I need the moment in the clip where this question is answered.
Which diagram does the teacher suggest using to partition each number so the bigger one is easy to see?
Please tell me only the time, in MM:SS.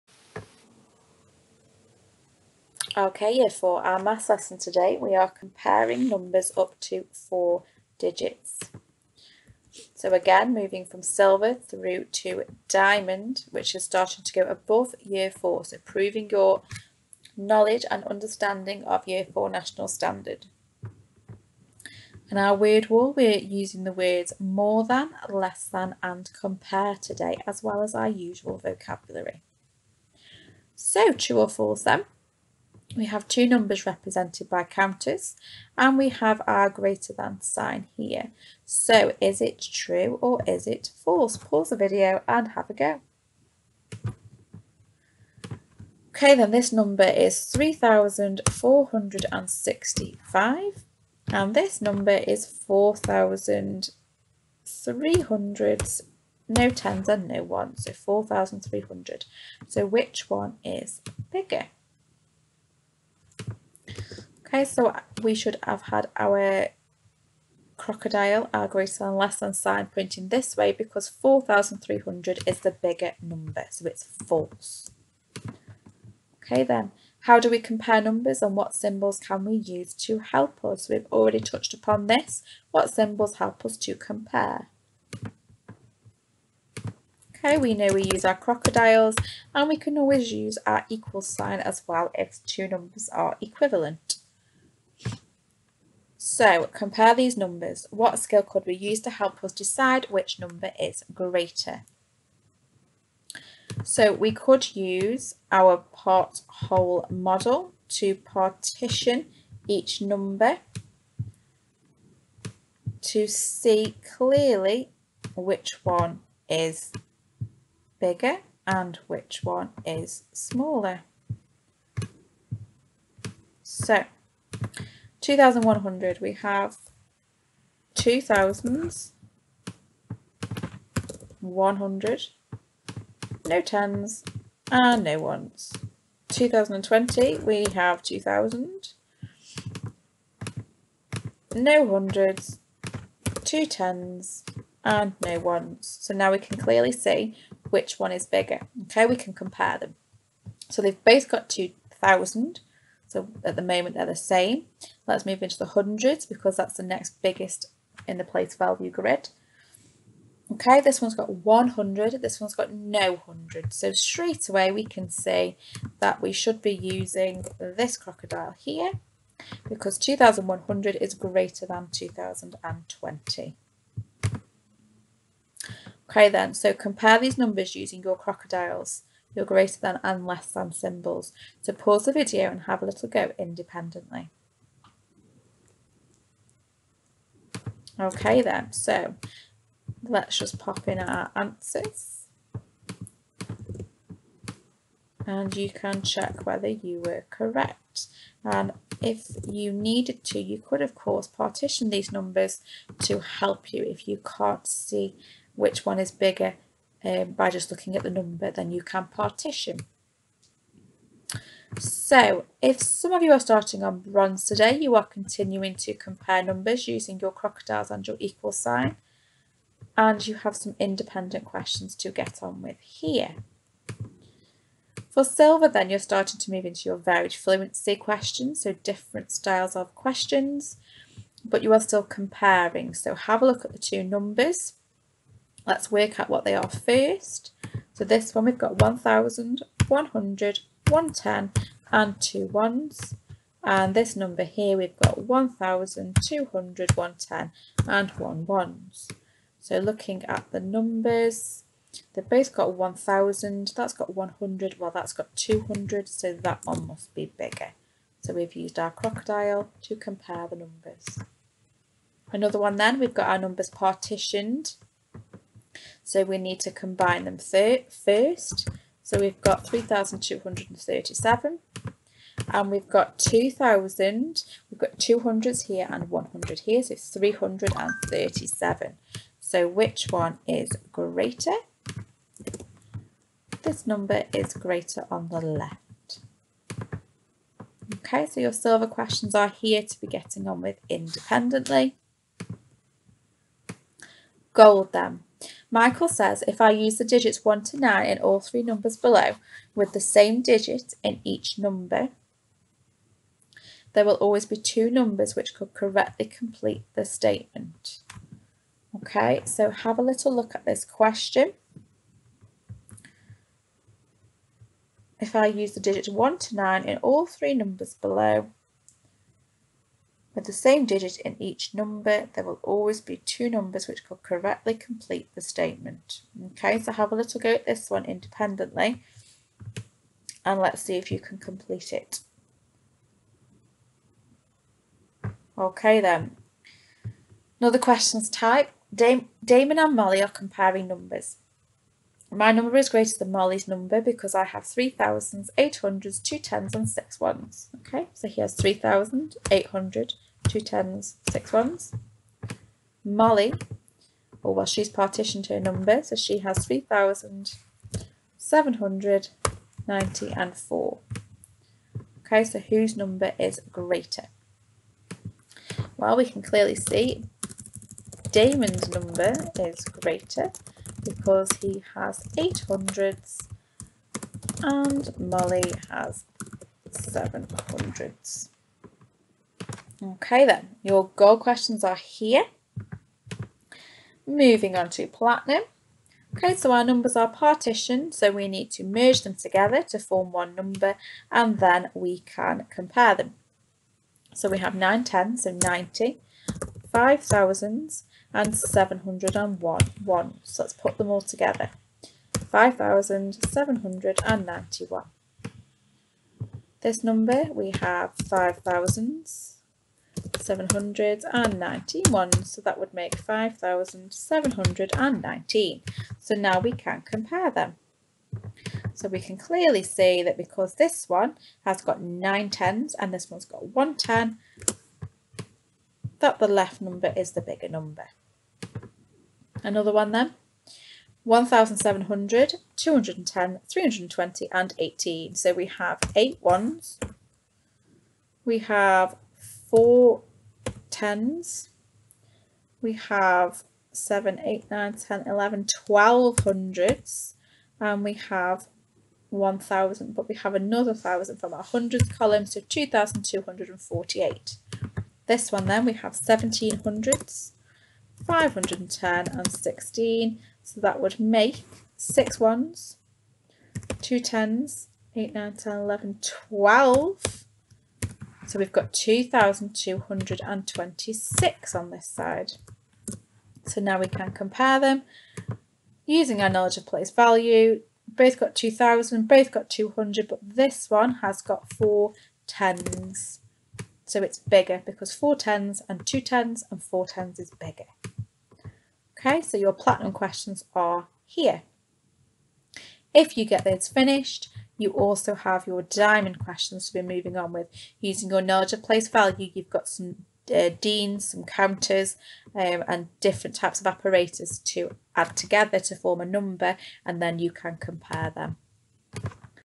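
01:45.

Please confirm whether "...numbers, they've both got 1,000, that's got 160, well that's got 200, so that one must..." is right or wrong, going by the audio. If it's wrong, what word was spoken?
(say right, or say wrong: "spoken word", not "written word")
wrong: "100", not "160".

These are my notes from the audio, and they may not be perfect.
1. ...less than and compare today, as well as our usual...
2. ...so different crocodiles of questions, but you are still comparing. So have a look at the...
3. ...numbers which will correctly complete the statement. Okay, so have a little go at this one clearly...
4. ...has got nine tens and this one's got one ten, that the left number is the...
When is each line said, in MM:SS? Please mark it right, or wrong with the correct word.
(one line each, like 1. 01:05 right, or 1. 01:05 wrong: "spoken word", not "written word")
1. 00:25 right
2. 03:48 wrong: "styles", not "crocodiles"
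3. 05:23 wrong: "independently", not "clearly"
4. 07:01 right.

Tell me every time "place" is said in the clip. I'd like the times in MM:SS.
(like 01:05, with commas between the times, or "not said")
02:38, 07:56, 08:18.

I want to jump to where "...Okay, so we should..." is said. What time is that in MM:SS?
01:04.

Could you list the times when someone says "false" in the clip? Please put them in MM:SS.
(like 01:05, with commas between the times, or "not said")
00:31, 00:41, 01:14.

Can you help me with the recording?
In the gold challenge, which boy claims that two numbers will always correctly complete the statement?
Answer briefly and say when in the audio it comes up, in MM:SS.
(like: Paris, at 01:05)
Michael, at 04:55.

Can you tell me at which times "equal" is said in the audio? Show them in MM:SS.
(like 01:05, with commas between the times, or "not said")
01:30, 03:38.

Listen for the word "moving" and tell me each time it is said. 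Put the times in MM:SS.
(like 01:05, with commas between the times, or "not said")
00:10, 06:24, 08:17.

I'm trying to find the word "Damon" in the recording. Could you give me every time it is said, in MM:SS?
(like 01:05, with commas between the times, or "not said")
05:38, 06:08.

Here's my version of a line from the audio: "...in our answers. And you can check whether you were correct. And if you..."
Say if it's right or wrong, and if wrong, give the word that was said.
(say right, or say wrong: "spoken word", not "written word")
right.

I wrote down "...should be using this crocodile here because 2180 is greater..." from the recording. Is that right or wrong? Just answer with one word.
wrong.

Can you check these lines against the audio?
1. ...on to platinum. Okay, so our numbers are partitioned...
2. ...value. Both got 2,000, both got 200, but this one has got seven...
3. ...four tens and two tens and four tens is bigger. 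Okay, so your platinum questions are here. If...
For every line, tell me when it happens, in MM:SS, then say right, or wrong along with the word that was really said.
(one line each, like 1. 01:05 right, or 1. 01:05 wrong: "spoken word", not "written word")
1. 06:24 right
2. 07:57 wrong: "four", not "seven"
3. 08:05 right.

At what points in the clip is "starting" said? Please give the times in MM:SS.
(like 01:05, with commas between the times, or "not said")
00:13, 03:33, 03:45.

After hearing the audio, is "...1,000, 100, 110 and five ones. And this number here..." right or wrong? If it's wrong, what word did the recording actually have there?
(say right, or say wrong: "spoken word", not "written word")
wrong: "two", not "five".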